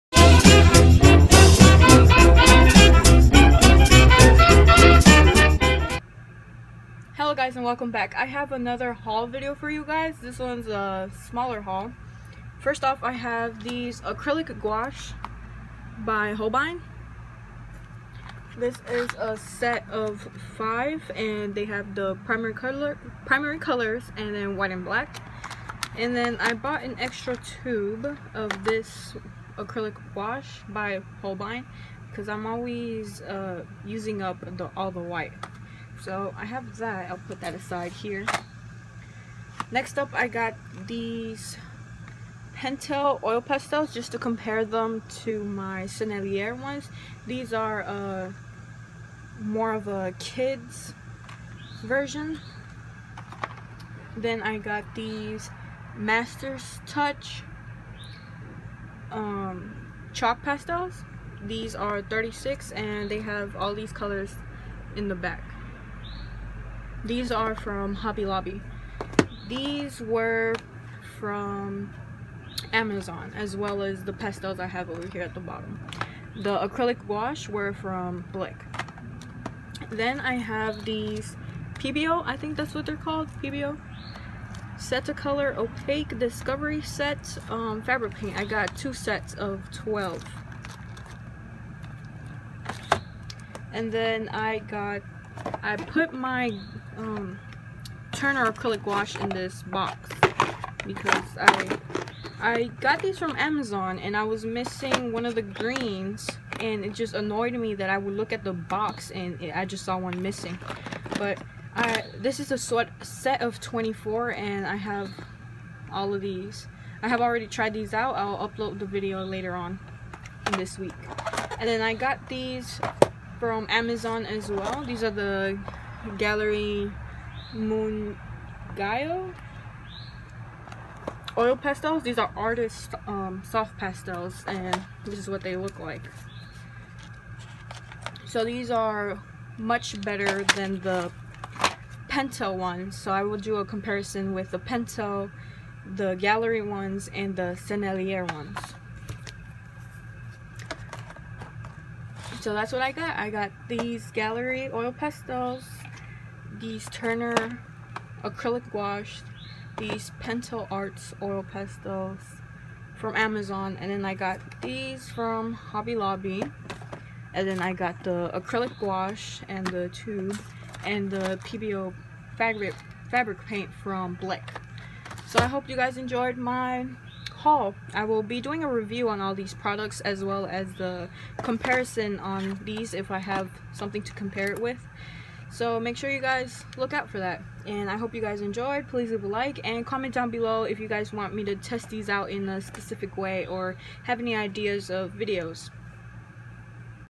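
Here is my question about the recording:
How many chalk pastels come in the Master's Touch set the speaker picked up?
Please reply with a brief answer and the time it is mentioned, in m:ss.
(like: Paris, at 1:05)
36, at 1:02.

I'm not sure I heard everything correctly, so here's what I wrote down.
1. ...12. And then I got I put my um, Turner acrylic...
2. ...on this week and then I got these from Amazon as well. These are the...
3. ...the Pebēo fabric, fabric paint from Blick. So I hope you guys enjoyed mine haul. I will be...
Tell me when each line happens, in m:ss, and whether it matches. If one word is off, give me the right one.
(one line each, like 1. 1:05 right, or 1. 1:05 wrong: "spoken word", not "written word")
1. 1:29 right
2. 1:59 right
3. 2:51 right.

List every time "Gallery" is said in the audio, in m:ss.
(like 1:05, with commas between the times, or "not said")
2:06, 2:26, 2:34.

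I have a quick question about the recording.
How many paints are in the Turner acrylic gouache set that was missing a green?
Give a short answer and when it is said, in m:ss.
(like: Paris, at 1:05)
24, at 1:53.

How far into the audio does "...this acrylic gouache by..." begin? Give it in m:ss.
0:28.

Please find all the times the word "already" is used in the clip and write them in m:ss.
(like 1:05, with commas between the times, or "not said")
1:57.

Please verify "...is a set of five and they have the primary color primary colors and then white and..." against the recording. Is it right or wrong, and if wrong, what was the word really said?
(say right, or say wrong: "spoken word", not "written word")
right.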